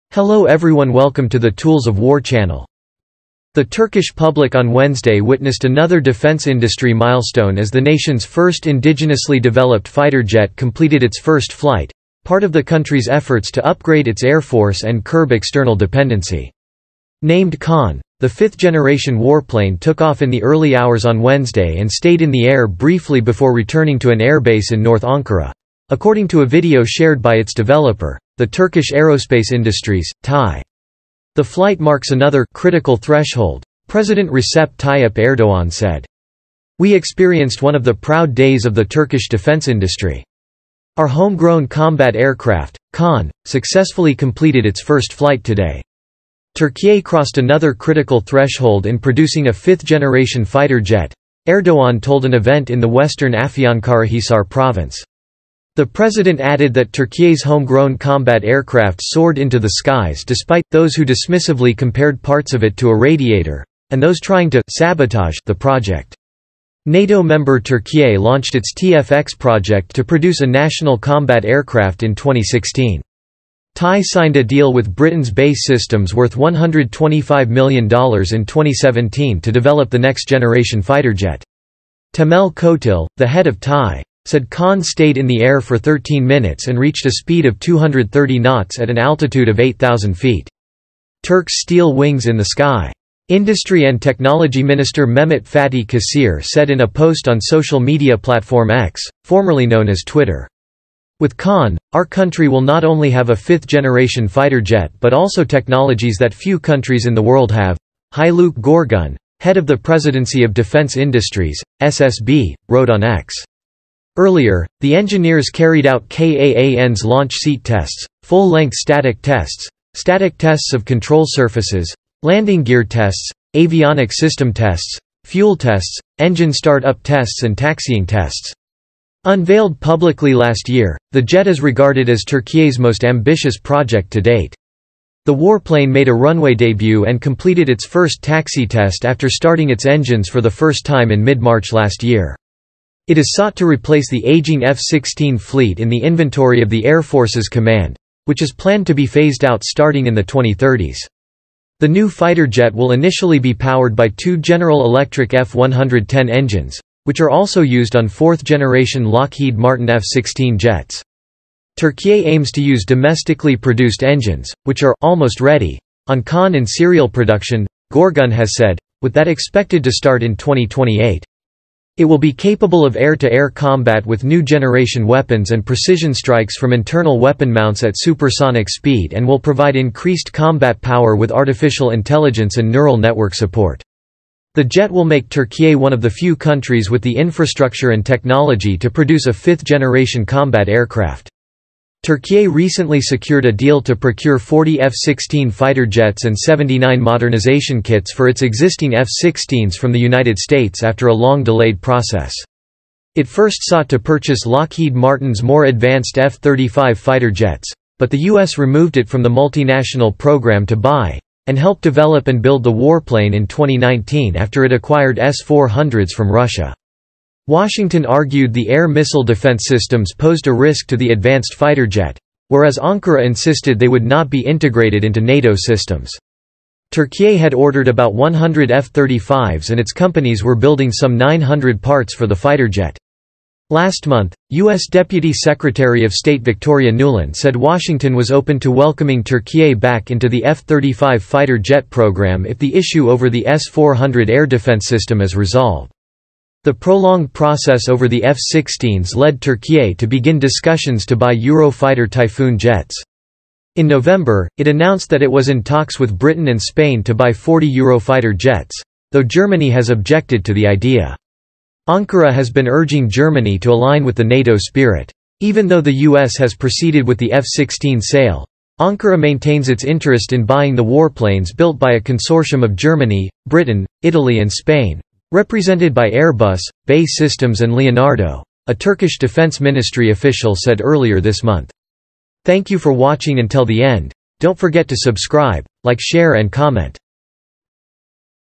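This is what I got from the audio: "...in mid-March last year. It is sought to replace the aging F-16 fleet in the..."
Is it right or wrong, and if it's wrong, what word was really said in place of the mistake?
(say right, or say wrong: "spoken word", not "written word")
right.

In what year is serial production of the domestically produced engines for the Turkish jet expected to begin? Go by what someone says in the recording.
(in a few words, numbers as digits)
2028.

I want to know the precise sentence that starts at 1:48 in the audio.
Haluk Gorgun, head of the Presidency of Defense Industries, SSB, wrote on X.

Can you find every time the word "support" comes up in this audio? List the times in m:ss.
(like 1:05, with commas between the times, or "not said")
3:03.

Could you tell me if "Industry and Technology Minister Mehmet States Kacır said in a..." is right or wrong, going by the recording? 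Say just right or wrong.
wrong.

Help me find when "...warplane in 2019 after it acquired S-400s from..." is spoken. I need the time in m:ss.
3:32.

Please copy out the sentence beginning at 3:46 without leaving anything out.
Turkey had ordered about 100 F-35s and its companies were building some 900 parts for the fighter jet.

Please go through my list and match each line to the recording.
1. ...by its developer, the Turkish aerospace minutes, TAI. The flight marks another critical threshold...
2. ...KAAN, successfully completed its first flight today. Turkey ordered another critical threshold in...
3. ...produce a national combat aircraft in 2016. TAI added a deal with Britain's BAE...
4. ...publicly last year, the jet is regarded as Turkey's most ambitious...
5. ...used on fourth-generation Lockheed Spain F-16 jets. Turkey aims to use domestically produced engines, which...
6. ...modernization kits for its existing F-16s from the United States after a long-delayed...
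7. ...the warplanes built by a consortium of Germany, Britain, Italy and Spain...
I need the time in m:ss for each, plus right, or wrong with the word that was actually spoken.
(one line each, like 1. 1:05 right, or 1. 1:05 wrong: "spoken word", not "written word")
1. 0:27 wrong: "industries", not "minutes"
2. 0:42 wrong: "crossed", not "ordered"
3. 1:10 wrong: "signed", not "added"
4. 2:09 right
5. 2:37 wrong: "Martin", not "Spain"
6. 3:16 right
7. 4:30 right.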